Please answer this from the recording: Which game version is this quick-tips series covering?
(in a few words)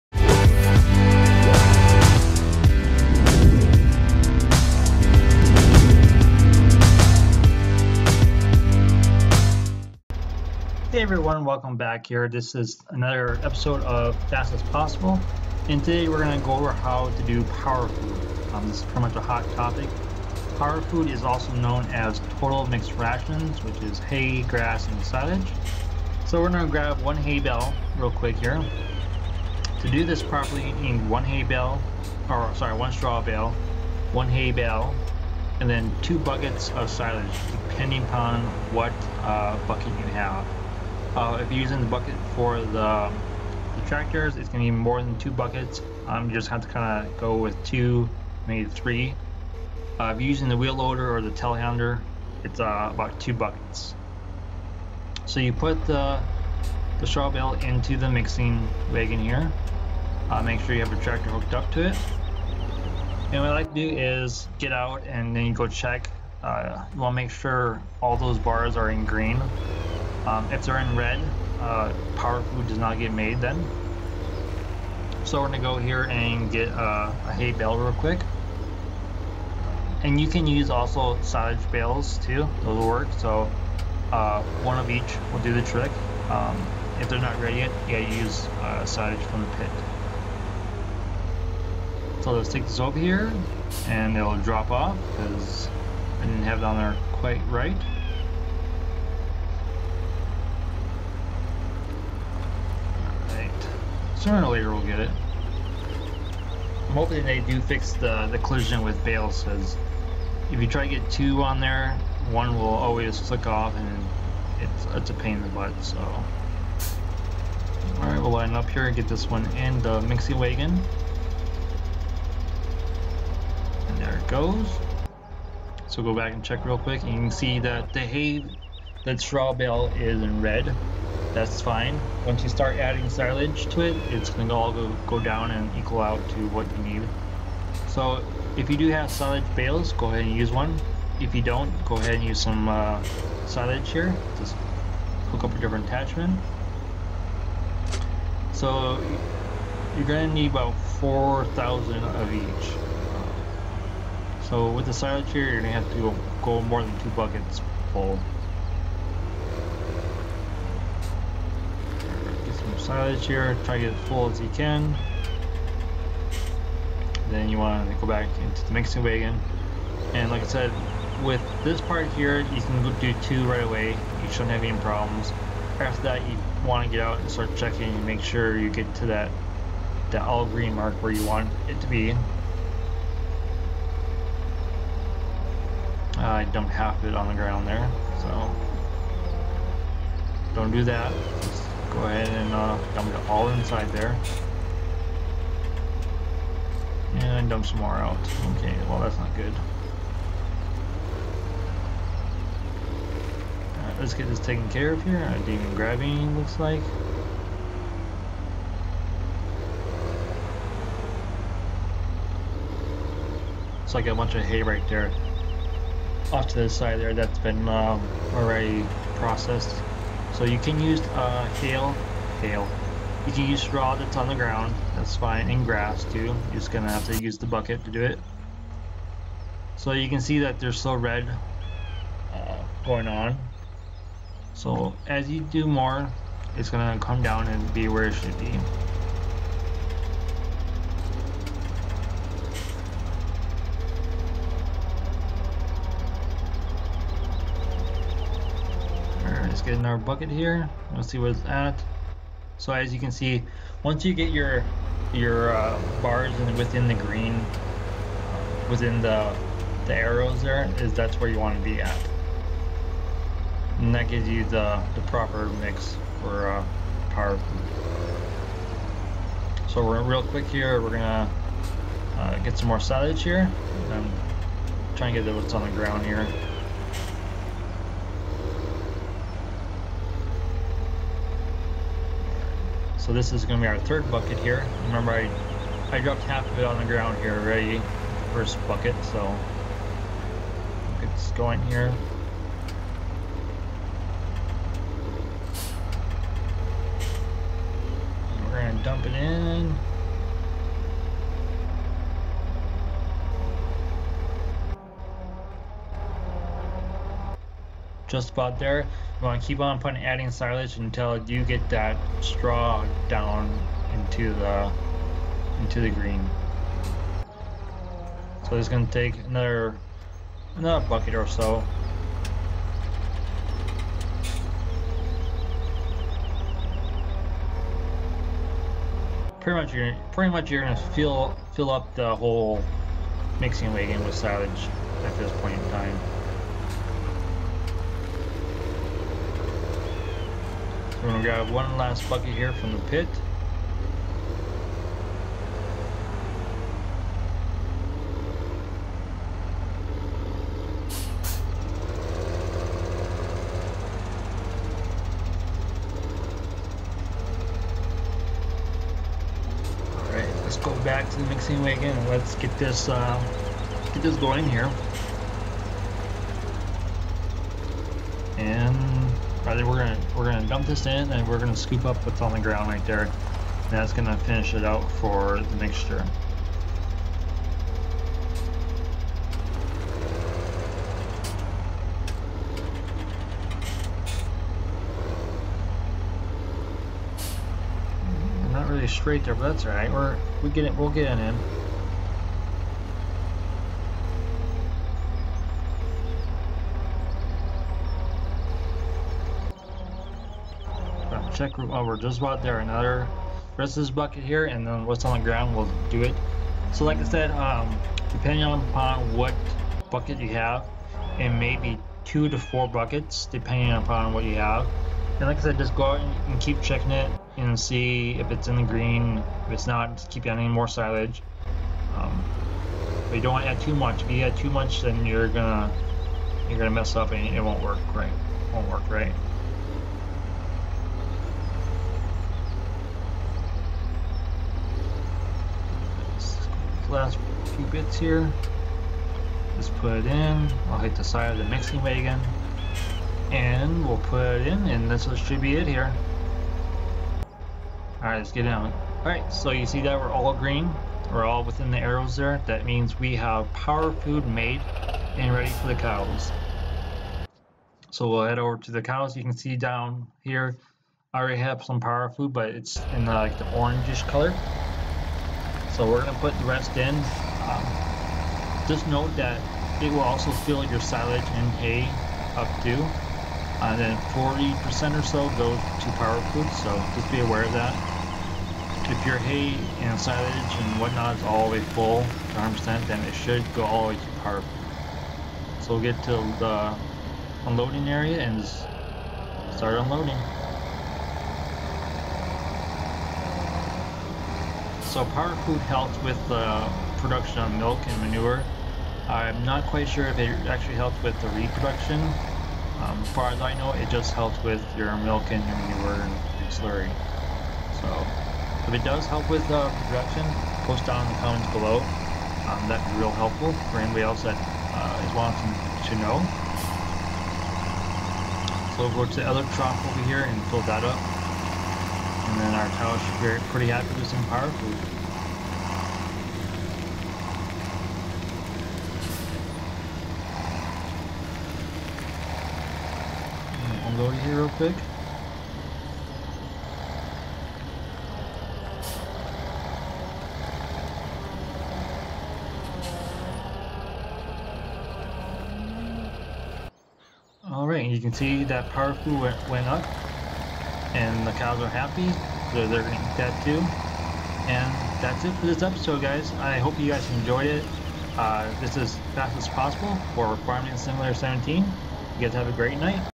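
Farming Simulator 17.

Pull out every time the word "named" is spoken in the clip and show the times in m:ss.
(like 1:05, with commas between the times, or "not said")
not said.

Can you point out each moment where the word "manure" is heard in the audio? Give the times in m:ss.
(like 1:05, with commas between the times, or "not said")
8:18, 8:25.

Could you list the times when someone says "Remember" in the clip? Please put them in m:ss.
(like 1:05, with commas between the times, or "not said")
4:44.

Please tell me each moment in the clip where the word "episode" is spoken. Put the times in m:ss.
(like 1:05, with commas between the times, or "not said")
0:13, 9:15.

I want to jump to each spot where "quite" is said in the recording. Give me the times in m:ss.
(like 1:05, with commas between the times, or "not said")
1:37, 8:19.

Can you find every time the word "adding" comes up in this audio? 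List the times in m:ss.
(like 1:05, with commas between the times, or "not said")
2:12, 5:10, 7:00.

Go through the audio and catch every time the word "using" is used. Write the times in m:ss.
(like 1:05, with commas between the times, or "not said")
0:41, 0:50.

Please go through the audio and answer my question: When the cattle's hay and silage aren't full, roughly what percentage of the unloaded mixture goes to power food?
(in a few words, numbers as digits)
40%.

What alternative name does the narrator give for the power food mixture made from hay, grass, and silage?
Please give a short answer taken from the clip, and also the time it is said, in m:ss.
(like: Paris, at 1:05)
Total mixed rations, at 0:22.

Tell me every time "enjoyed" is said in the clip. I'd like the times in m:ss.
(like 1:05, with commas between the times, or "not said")
9:17.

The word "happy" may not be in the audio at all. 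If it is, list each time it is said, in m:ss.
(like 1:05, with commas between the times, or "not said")
8:43, 9:11.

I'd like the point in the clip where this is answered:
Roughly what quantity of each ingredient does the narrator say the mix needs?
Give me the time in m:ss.
2:30.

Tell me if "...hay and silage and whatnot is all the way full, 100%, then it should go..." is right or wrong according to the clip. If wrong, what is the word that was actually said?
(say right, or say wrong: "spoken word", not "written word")
right.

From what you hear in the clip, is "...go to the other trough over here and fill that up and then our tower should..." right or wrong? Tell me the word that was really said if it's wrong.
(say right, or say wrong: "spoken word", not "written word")
right.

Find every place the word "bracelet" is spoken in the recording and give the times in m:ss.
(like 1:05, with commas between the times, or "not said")
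not said.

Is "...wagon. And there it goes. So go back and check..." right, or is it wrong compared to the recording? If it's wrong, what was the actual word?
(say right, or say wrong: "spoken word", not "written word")
right.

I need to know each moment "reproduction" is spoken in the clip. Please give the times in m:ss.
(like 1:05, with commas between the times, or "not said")
8:21.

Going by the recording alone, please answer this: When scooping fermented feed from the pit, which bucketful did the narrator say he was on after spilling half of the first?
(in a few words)
Third.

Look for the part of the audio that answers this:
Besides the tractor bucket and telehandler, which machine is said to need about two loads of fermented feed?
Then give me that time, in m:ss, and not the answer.
0:50.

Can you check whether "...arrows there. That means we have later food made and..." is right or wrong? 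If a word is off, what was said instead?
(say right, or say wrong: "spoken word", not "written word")
wrong: "power", not "later".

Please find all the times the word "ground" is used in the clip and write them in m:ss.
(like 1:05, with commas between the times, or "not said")
3:07, 3:44, 4:35, 4:46, 6:12, 6:45.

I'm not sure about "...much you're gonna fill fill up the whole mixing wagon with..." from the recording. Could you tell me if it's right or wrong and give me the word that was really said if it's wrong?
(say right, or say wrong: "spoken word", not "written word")
right.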